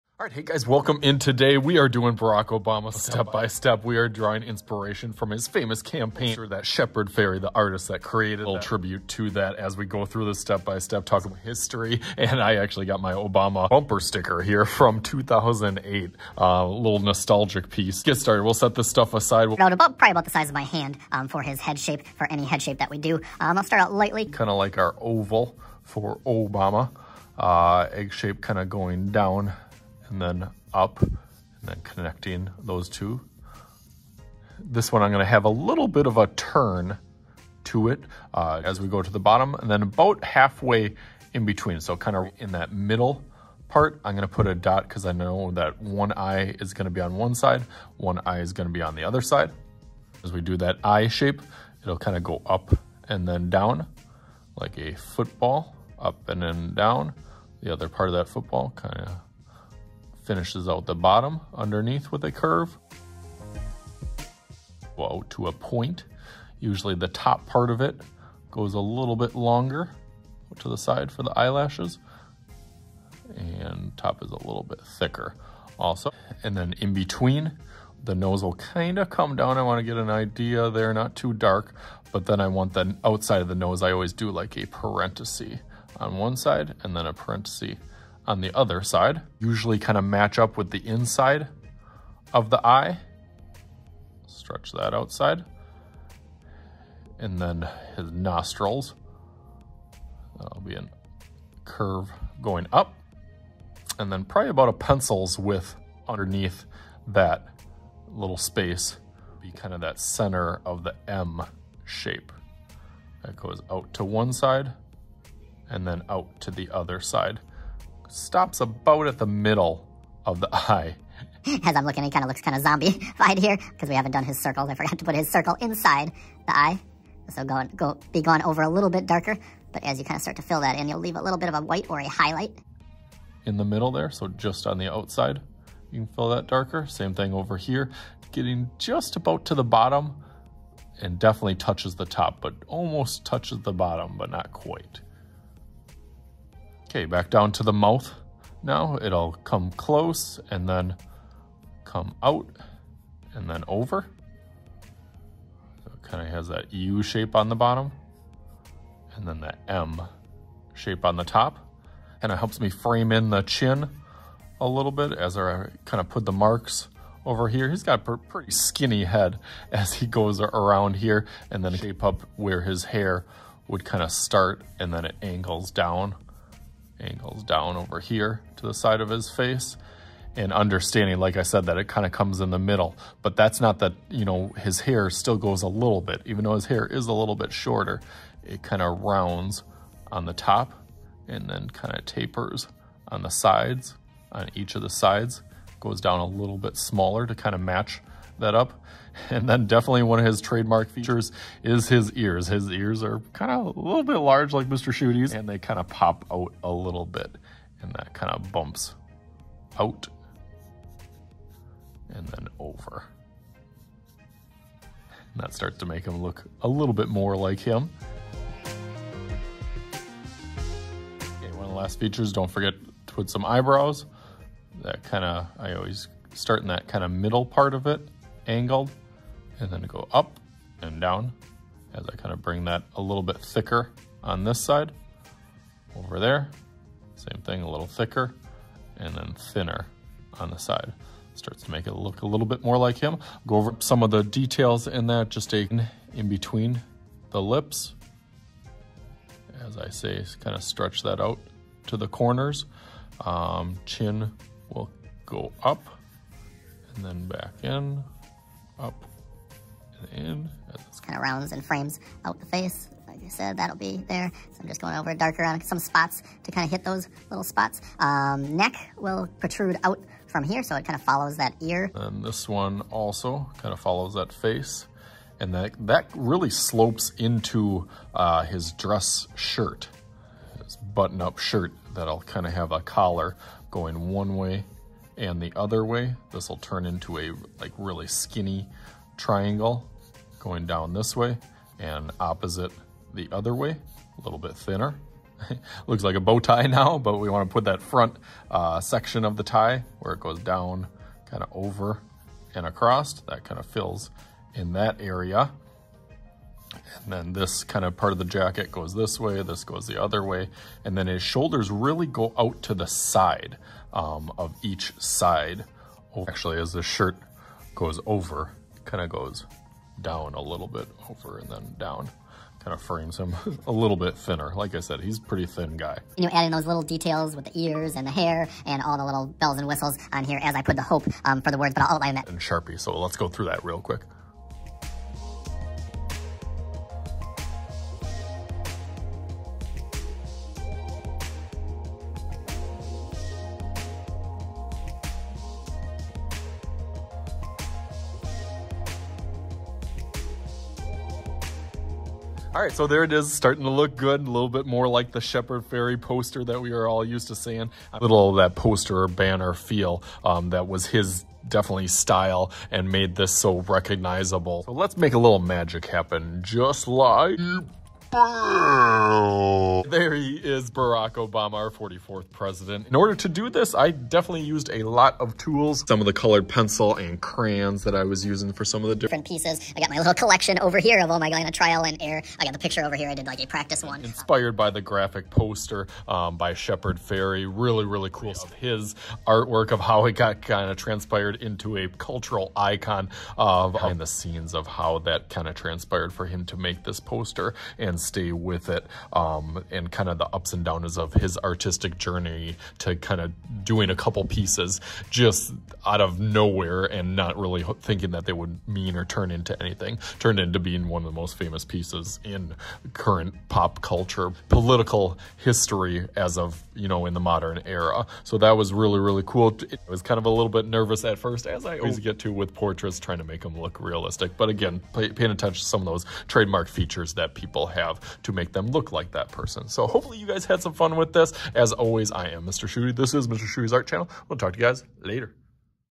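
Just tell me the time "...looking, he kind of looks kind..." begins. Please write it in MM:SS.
02:01.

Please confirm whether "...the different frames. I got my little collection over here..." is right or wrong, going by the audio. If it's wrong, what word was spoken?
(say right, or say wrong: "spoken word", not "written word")
wrong: "pieces", not "frames".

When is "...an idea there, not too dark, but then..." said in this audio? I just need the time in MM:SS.
01:19.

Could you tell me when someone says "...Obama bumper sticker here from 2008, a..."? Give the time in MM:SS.
00:13.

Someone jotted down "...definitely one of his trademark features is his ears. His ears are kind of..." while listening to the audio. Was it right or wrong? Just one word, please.
right.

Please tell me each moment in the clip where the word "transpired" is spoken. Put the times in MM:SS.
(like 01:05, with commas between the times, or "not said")
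06:30, 06:35.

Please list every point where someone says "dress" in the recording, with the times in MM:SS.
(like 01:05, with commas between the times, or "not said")
04:38.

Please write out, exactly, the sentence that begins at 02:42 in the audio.
And it helps me frame in the chin a little bit as I kind of put the marks over here.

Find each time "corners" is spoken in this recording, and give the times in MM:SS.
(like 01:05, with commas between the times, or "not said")
04:12.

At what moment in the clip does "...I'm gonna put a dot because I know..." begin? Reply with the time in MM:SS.
00:44.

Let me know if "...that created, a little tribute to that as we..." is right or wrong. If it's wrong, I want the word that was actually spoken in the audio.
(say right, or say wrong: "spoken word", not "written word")
right.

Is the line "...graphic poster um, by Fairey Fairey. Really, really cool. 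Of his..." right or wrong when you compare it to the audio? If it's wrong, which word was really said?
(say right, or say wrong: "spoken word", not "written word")
wrong: "Shepard", not "Fairey".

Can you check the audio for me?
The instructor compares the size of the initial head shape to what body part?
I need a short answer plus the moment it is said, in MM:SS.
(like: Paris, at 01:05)
size of my hand, at 00:20.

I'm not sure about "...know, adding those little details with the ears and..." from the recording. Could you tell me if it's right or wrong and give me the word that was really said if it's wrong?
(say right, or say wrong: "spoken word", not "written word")
right.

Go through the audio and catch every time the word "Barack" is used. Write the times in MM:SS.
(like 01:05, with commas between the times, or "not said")
00:02, 06:10.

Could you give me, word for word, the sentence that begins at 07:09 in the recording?
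So hopefully you guys had some fun with this.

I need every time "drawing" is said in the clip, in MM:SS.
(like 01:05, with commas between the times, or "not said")
00:04.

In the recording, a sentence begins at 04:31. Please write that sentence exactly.
And this one also kind of follows that face.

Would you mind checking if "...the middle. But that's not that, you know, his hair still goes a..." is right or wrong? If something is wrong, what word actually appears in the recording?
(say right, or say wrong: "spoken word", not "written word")
right.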